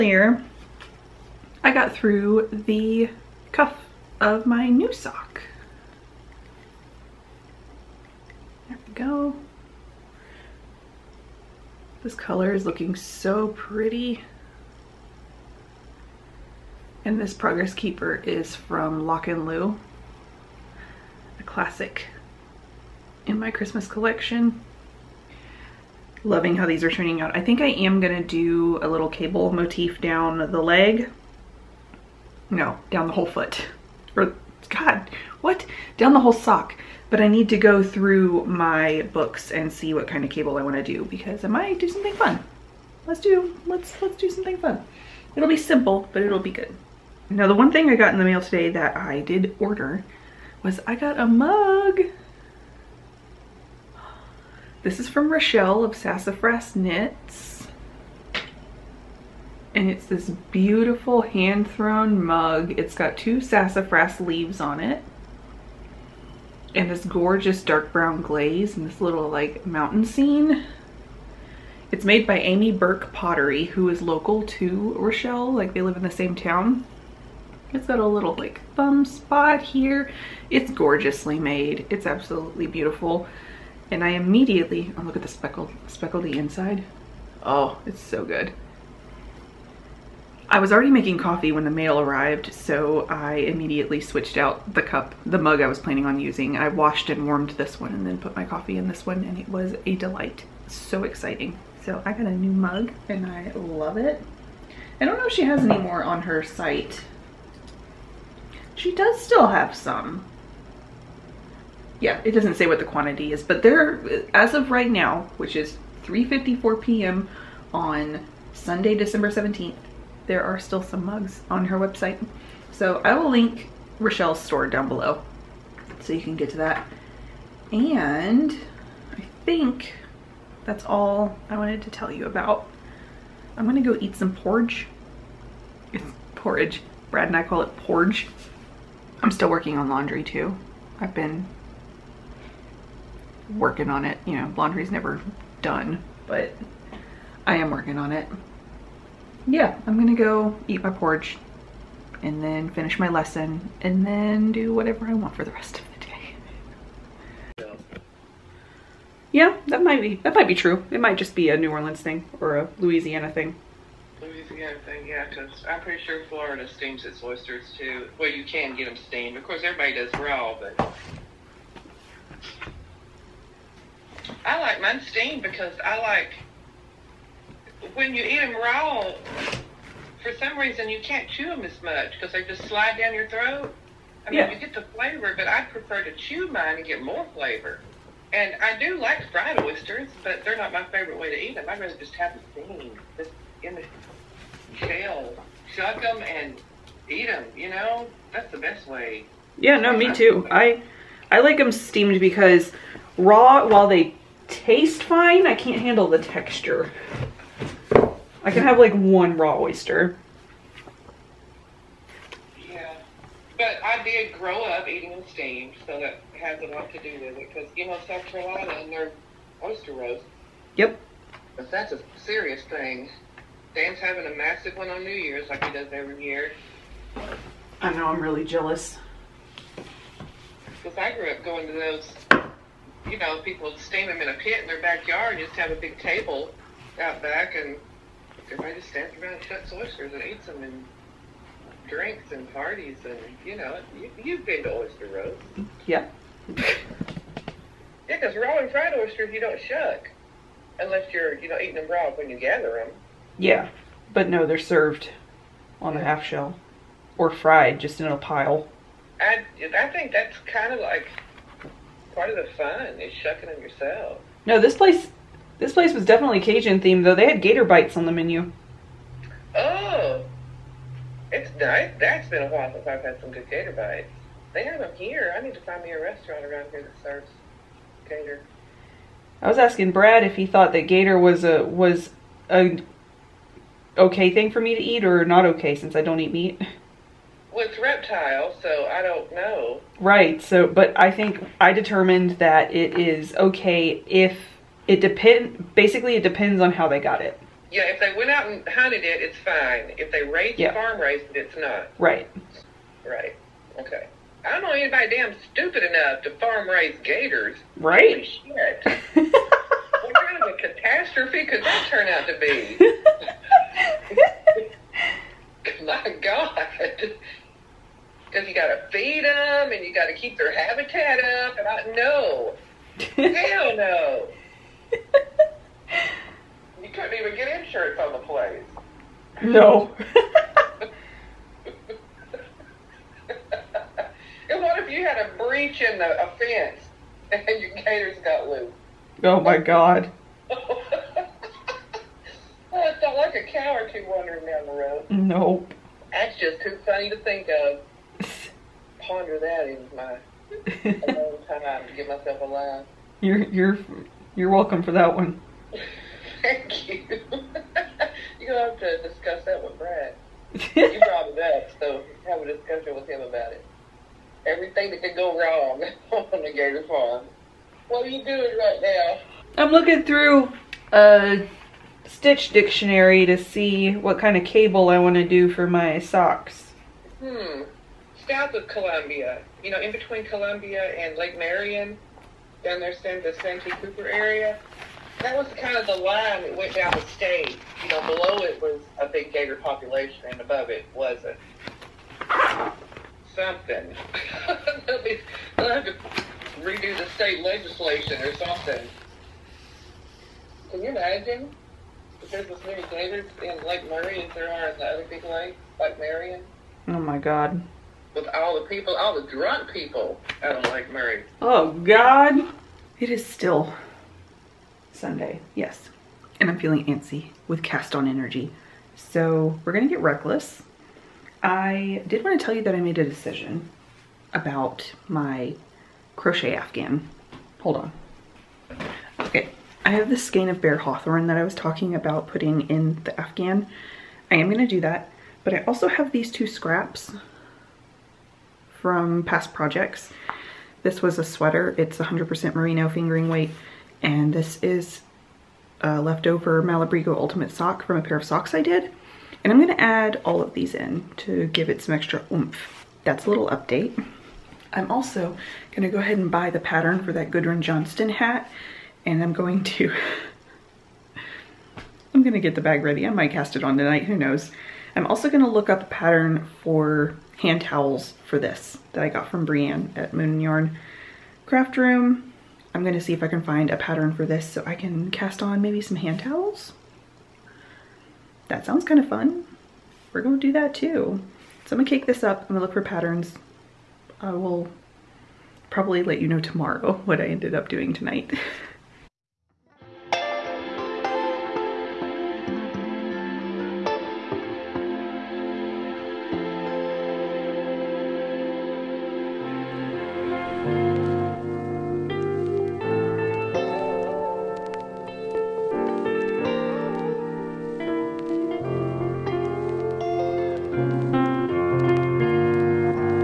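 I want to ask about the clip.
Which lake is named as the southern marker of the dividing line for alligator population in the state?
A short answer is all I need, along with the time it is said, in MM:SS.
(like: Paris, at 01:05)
Lake Marion, at 06:21.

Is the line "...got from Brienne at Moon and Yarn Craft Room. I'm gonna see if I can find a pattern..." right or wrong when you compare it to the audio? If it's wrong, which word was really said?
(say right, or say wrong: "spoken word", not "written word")
right.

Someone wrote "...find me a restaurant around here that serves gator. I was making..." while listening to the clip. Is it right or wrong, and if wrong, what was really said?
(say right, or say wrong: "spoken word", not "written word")
wrong: "asking", not "making".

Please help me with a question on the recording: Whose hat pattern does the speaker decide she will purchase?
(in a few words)
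Gudrun Johnston.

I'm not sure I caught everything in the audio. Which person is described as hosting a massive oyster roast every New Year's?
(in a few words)
Dan.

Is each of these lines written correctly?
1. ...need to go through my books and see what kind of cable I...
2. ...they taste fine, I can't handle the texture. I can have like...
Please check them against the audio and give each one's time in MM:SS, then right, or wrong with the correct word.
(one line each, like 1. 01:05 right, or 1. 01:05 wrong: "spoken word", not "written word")
1. 00:37 right
2. 03:23 right.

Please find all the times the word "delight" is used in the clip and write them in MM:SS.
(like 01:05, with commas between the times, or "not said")
01:39.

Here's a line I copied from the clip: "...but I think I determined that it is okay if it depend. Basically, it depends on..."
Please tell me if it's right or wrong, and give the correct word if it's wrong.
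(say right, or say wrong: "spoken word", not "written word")
right.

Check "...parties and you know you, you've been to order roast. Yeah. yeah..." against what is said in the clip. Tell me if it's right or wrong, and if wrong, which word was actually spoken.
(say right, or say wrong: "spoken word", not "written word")
wrong: "oyster", not "order".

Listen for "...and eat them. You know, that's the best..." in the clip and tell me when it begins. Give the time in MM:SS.
03:16.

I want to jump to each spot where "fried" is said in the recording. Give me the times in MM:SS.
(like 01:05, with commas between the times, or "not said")
03:09, 04:08, 04:17.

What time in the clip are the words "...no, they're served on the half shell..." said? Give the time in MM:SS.
04:14.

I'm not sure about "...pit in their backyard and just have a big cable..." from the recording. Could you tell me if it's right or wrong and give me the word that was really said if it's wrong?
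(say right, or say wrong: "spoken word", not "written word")
wrong: "table", not "cable".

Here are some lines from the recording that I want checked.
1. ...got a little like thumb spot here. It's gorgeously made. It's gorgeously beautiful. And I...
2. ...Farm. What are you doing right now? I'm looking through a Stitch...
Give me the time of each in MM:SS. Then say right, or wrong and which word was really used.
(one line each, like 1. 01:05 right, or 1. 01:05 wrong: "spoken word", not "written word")
1. 01:17 wrong: "absolutely", not "gorgeously"
2. 06:06 right.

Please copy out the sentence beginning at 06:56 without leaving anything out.
And I'm feeling antsy with cast on energy.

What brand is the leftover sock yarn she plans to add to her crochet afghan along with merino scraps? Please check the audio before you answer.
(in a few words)
Malabrigo Ultimate.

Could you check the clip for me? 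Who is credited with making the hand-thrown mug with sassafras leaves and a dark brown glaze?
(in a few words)
Amy Burke Pottery.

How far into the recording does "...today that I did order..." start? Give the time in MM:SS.
00:48.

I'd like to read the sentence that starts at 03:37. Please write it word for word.
Because you know South Carolina and their oyster roast.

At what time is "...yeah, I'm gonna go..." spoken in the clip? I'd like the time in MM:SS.
02:29.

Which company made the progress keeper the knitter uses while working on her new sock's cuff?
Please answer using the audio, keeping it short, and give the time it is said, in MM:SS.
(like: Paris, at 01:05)
Lock and Lou, at 00:19.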